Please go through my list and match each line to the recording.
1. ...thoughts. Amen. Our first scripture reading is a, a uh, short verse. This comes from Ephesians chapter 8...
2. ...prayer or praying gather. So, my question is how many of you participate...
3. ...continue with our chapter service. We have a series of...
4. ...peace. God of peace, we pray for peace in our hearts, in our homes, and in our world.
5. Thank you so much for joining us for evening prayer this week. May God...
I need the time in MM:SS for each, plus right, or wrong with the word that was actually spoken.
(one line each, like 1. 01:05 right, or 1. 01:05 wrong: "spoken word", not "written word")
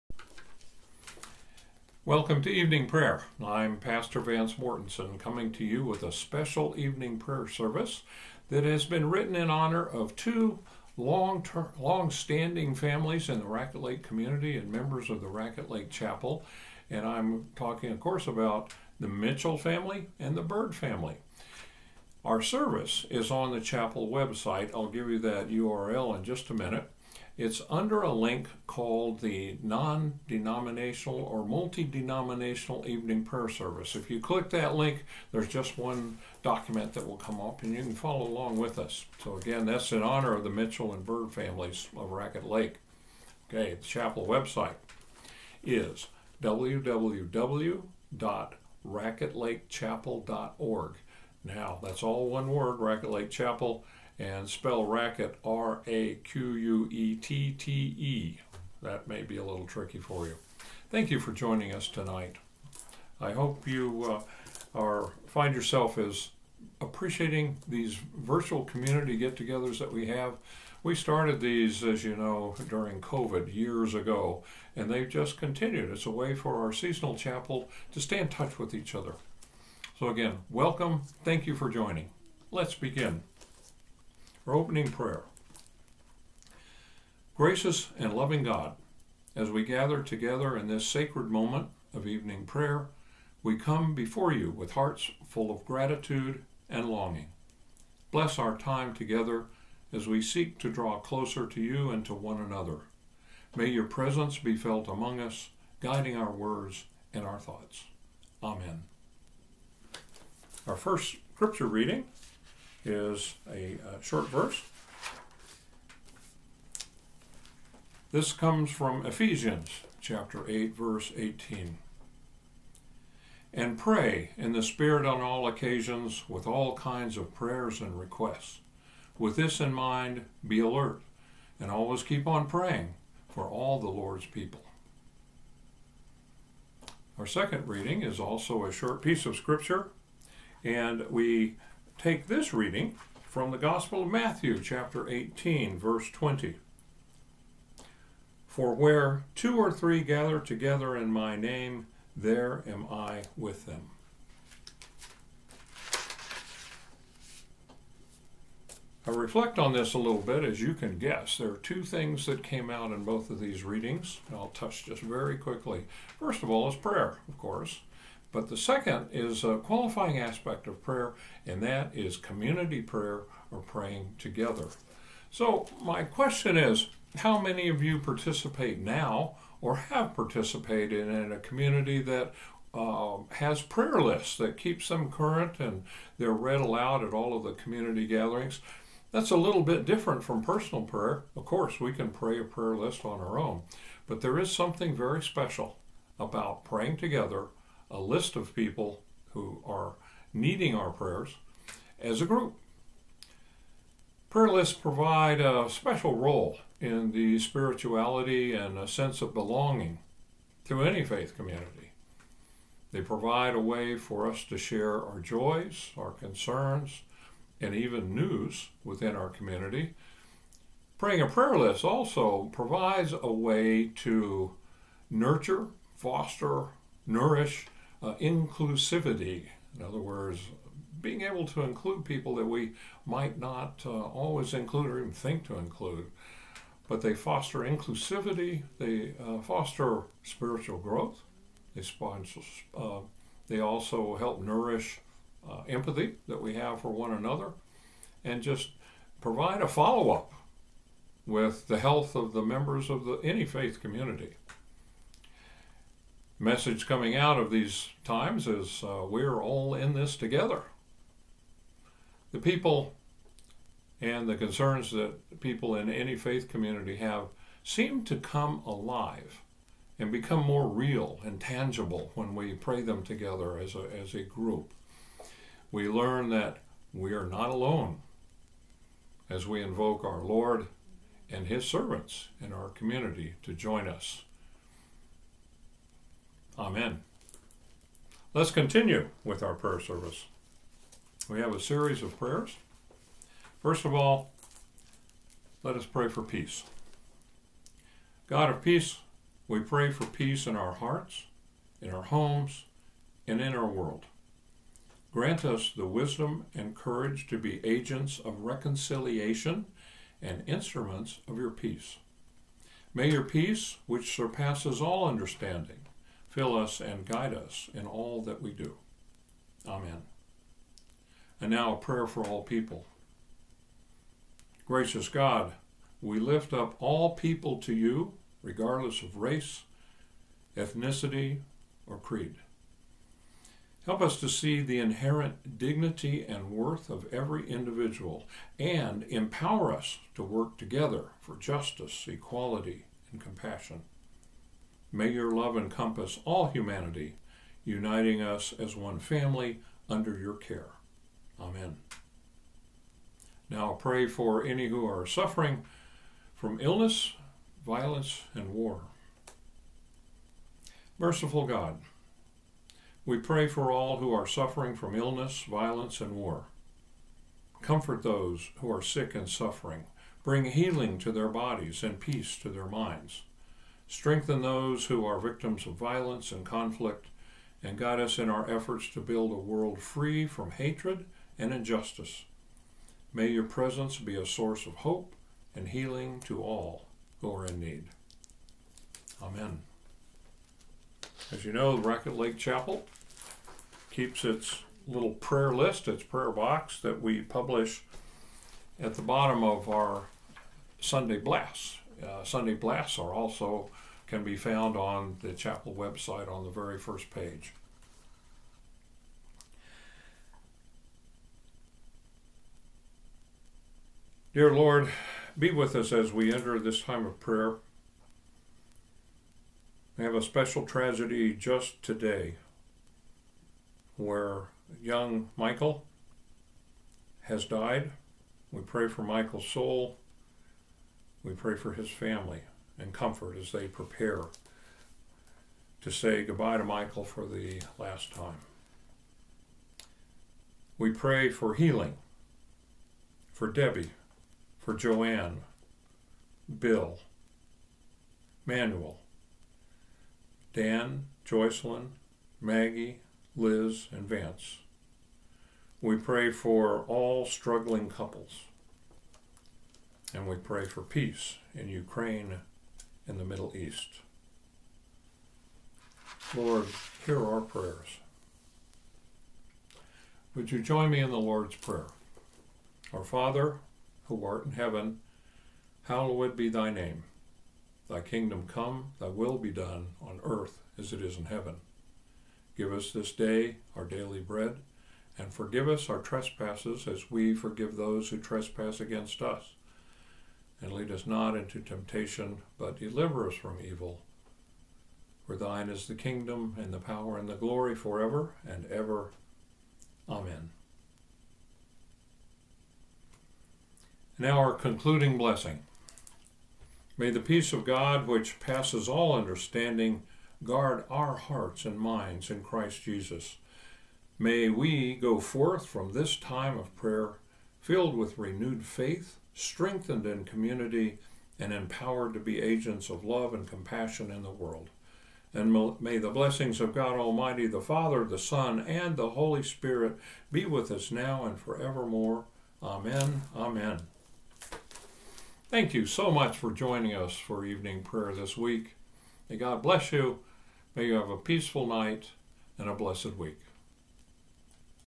1. 01:47 right
2. 02:52 wrong: "together", not "gather"
3. 04:48 wrong: "prayer", not "chapter"
4. 04:56 right
5. 08:55 right.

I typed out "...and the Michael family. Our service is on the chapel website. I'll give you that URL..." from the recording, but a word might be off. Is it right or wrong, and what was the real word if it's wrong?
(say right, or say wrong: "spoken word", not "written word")
wrong: "Bird", not "Michael".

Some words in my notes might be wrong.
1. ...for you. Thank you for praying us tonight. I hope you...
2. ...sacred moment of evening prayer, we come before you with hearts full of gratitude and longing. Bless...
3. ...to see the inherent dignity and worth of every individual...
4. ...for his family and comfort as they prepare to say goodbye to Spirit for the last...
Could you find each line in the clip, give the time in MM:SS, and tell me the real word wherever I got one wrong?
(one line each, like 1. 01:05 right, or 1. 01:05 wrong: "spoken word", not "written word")
1. 00:59 wrong: "joining", not "praying"
2. 01:30 right
3. 05:34 right
4. 07:11 wrong: "Michael", not "Spirit".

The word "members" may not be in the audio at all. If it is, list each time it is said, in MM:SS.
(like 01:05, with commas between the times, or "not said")
00:14, 04:12.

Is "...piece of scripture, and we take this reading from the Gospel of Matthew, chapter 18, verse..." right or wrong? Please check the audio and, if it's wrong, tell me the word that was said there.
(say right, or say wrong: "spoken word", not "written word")
right.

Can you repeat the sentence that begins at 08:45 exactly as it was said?
And may the blessings of God Almighty, the Father, the Son, and the Holy Spirit be with us now and forevermore.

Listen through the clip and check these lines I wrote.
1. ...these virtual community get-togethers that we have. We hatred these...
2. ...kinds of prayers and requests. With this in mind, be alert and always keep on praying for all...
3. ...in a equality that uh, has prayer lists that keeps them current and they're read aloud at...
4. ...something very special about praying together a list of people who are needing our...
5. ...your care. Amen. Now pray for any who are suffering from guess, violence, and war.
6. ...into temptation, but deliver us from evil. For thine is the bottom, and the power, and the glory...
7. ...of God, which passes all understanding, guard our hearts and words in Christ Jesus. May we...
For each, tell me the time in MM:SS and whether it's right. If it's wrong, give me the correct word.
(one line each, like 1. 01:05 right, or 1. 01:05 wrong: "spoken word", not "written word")
1. 01:07 wrong: "started", not "hatred"
2. 02:06 right
3. 03:01 wrong: "community", not "equality"
4. 03:14 right
5. 05:50 wrong: "illness", not "guess"
6. 08:11 wrong: "kingdom", not "bottom"
7. 08:27 wrong: "minds", not "words".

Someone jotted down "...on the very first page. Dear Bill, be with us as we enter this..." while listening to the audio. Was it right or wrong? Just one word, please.
wrong.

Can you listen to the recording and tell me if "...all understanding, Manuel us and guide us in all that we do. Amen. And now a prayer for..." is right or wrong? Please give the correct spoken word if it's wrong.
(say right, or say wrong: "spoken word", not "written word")
wrong: "Fill", not "Manuel".